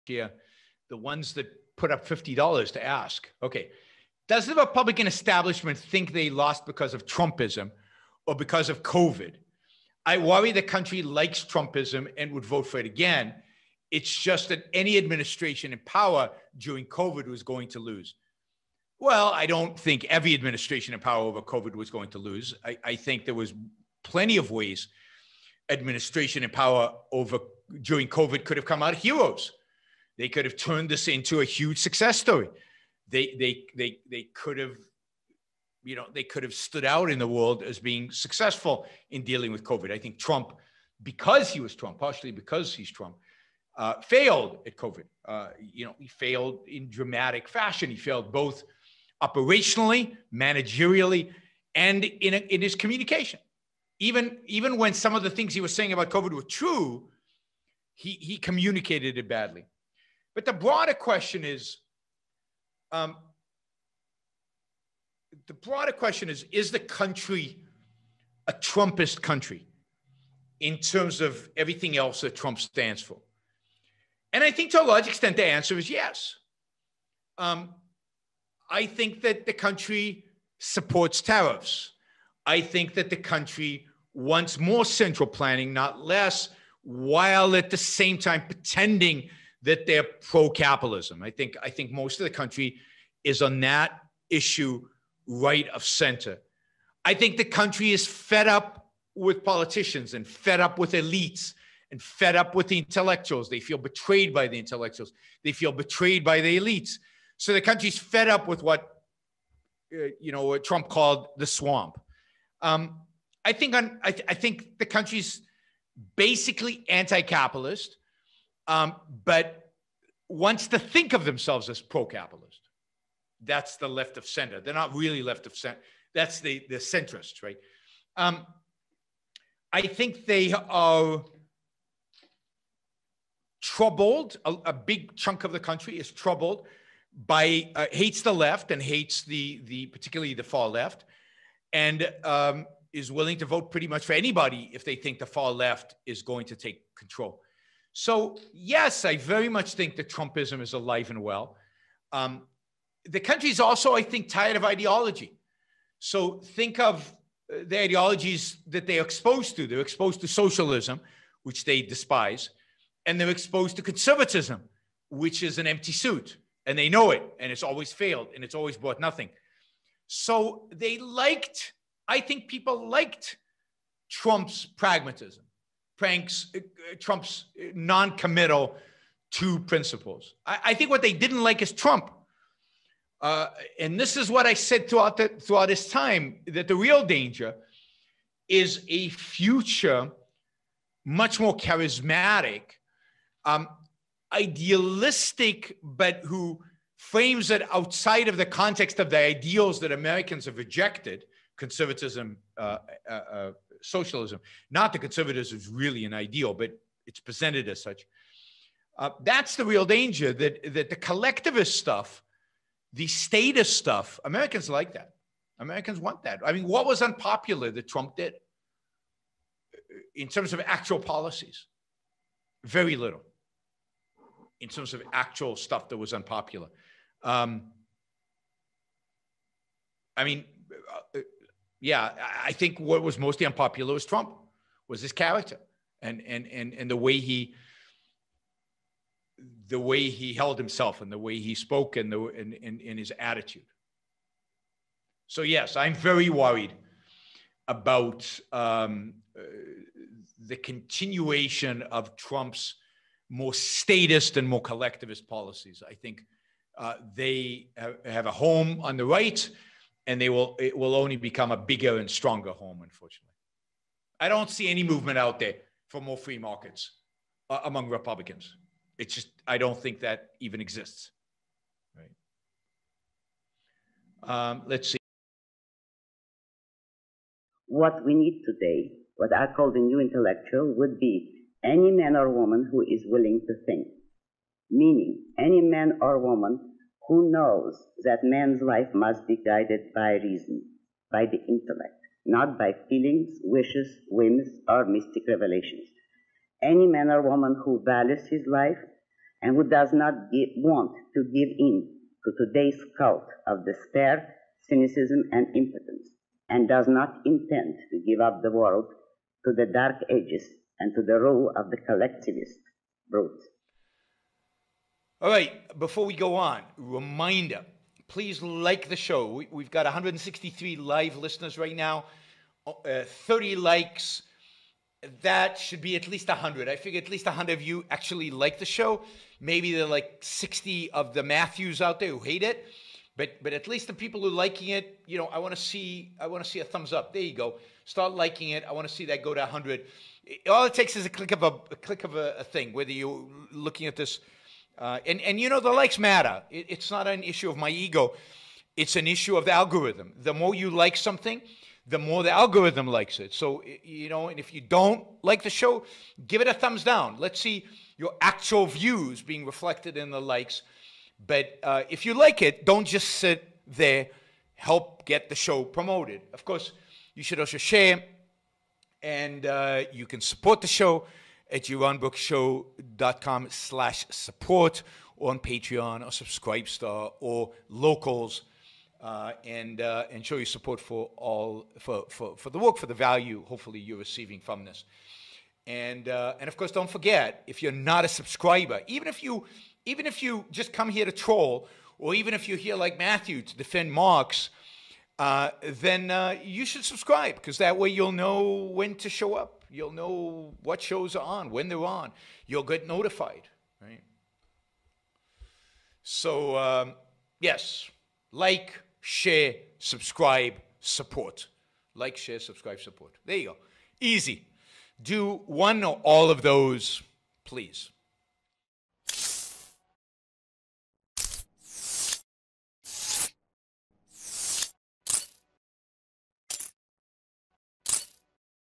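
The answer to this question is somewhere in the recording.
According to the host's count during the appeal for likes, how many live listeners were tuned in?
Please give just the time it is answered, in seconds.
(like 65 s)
319 s.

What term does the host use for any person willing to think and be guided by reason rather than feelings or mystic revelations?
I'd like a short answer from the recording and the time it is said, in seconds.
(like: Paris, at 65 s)
The new intellectual, at 279 s.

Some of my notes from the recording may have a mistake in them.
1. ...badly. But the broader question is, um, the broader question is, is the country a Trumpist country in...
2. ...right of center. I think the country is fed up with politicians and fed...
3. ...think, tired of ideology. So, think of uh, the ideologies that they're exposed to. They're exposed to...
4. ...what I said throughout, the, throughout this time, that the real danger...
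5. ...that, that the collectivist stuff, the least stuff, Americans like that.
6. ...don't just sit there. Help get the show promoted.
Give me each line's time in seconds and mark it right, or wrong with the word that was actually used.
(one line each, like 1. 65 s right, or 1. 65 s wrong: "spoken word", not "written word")
1. 59 s right
2. 95 s right
3. 154 s right
4. 184 s right
5. 210 s wrong: "statist", not "least"
6. 362 s right.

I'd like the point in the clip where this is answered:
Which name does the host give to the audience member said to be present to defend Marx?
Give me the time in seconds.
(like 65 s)
392 s.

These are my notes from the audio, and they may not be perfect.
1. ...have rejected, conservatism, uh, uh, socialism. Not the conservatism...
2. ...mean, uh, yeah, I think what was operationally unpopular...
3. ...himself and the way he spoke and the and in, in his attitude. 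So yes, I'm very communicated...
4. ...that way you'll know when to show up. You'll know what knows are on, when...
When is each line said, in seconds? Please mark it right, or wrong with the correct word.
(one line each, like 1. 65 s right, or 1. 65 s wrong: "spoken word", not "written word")
1. 200 s right
2. 230 s wrong: "mostly", not "operationally"
3. 240 s wrong: "worried", not "communicated"
4. 397 s wrong: "shows", not "knows".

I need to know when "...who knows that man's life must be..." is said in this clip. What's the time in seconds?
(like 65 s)
287 s.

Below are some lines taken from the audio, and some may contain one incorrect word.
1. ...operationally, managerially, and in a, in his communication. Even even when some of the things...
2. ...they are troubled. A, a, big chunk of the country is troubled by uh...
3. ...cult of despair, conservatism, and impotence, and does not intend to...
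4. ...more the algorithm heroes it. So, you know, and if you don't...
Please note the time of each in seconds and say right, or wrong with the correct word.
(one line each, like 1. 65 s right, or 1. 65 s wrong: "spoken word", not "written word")
1. 49 s right
2. 130 s right
3. 302 s wrong: "cynicism", not "conservatism"
4. 351 s wrong: "likes", not "heroes".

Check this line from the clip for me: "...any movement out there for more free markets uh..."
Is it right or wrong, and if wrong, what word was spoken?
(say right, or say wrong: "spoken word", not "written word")
right.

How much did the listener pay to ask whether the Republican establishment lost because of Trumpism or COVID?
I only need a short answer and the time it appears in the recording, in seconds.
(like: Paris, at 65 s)
$50, at 2 s.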